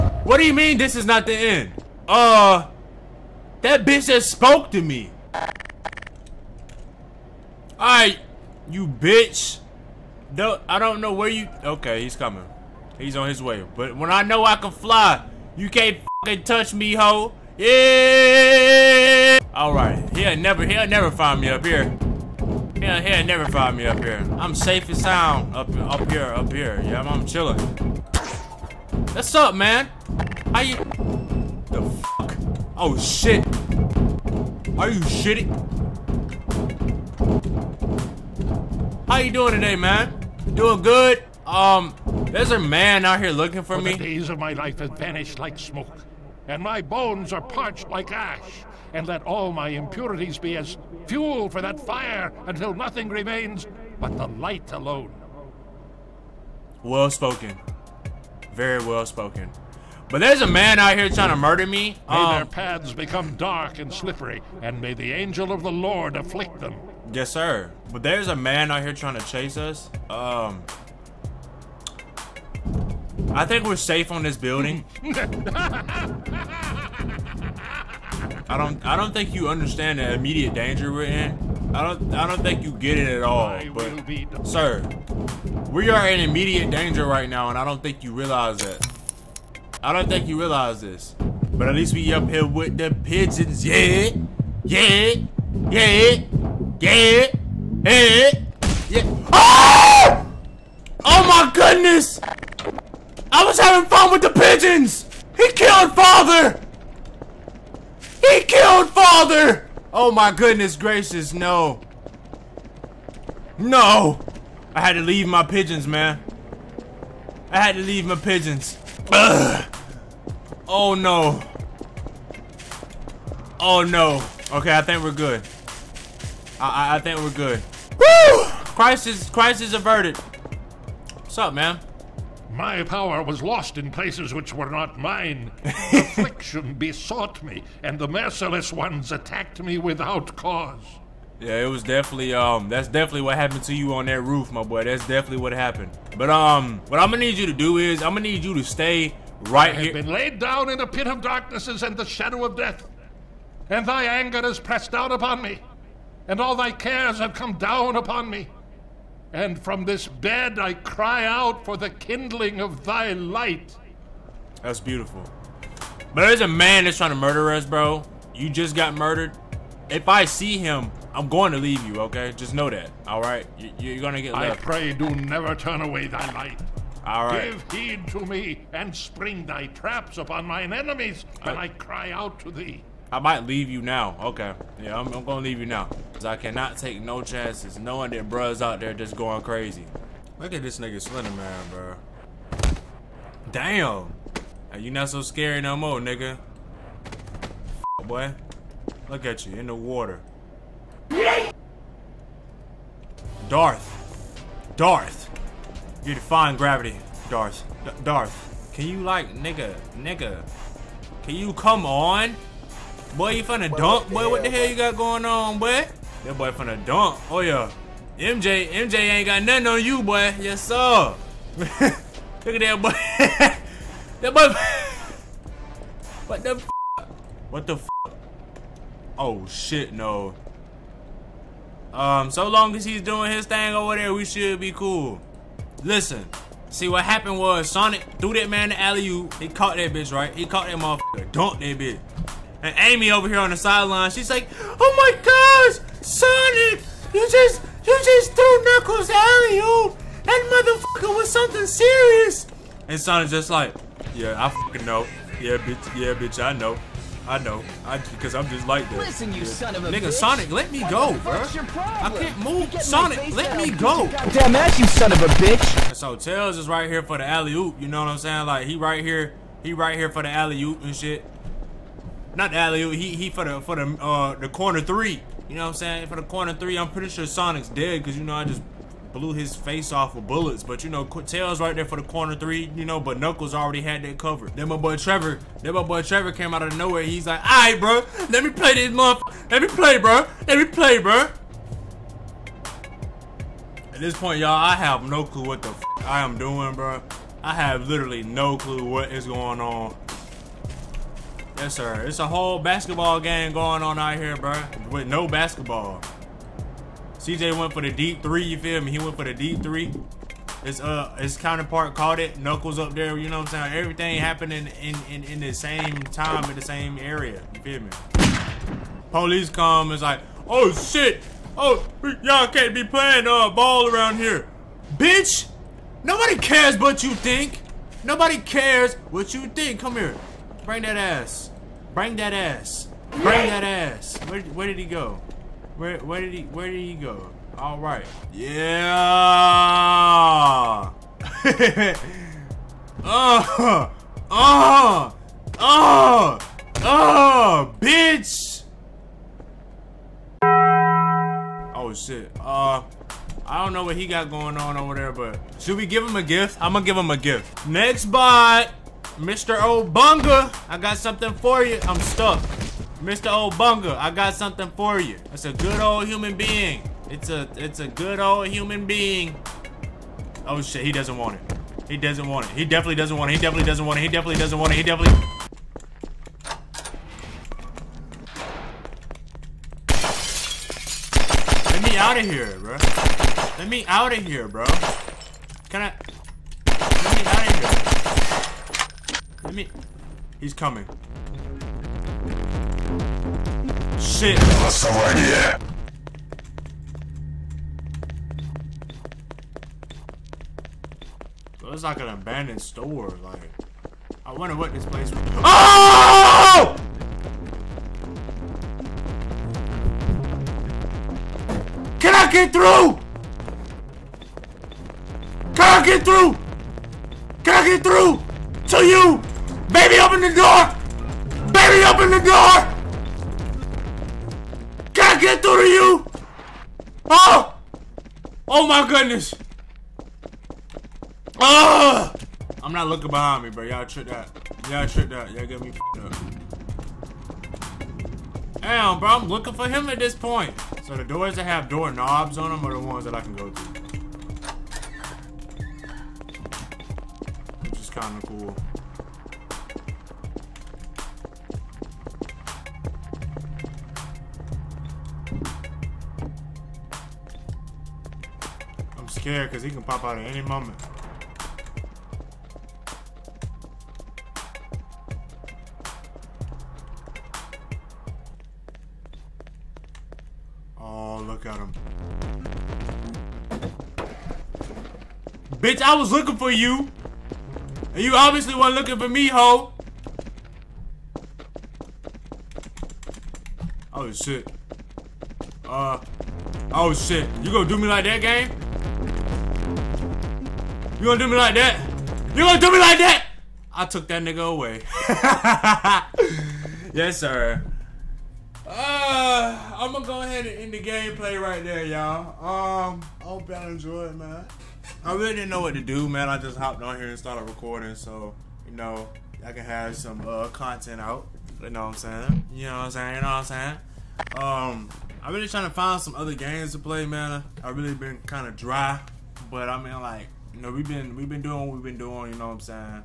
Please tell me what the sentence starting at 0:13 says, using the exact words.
But when I know I can fly, you can't fucking touch me, ho.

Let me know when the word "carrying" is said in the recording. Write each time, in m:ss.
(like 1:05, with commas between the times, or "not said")
not said.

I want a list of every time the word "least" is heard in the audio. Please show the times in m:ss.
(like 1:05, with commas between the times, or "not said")
1:31.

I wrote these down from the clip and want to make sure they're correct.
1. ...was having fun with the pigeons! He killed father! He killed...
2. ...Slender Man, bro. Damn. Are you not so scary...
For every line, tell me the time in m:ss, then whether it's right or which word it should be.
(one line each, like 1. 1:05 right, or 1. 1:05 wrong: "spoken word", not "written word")
1. 1:43 right
2. 3:11 right.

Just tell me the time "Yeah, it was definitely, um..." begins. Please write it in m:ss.
2:21.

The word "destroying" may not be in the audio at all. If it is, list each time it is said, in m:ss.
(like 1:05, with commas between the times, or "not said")
not said.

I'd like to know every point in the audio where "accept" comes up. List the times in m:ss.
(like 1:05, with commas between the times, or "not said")
not said.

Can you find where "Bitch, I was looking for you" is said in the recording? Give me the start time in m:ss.
7:55.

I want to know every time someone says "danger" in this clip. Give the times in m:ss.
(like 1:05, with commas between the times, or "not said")
1:20, 1:26.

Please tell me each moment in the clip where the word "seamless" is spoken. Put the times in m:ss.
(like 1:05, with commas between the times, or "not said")
not said.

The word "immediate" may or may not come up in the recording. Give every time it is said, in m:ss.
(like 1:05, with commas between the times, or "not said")
1:20, 1:26.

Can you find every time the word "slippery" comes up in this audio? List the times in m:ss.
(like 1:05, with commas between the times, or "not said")
1:03.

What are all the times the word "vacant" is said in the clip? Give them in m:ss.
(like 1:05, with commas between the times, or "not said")
not said.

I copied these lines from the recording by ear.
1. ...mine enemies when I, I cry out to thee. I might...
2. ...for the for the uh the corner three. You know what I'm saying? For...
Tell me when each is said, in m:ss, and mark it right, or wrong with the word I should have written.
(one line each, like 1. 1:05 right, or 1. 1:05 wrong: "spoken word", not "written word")
1. 3:00 right
2. 4:33 right.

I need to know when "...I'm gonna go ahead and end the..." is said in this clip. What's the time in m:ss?
8:19.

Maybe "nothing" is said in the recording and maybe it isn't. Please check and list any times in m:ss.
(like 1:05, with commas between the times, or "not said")
0:52, 3:39.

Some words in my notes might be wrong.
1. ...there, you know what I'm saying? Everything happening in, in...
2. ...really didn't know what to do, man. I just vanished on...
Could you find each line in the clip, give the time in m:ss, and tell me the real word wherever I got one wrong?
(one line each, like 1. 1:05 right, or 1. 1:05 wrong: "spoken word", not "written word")
1. 5:12 right
2. 8:25 wrong: "hopped", not "vanished".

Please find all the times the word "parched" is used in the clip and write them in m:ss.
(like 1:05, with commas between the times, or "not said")
0:47.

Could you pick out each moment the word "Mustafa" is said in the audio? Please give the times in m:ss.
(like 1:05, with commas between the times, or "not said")
not said.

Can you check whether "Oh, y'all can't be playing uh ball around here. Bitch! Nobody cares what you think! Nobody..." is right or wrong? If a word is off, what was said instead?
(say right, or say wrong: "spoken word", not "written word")
right.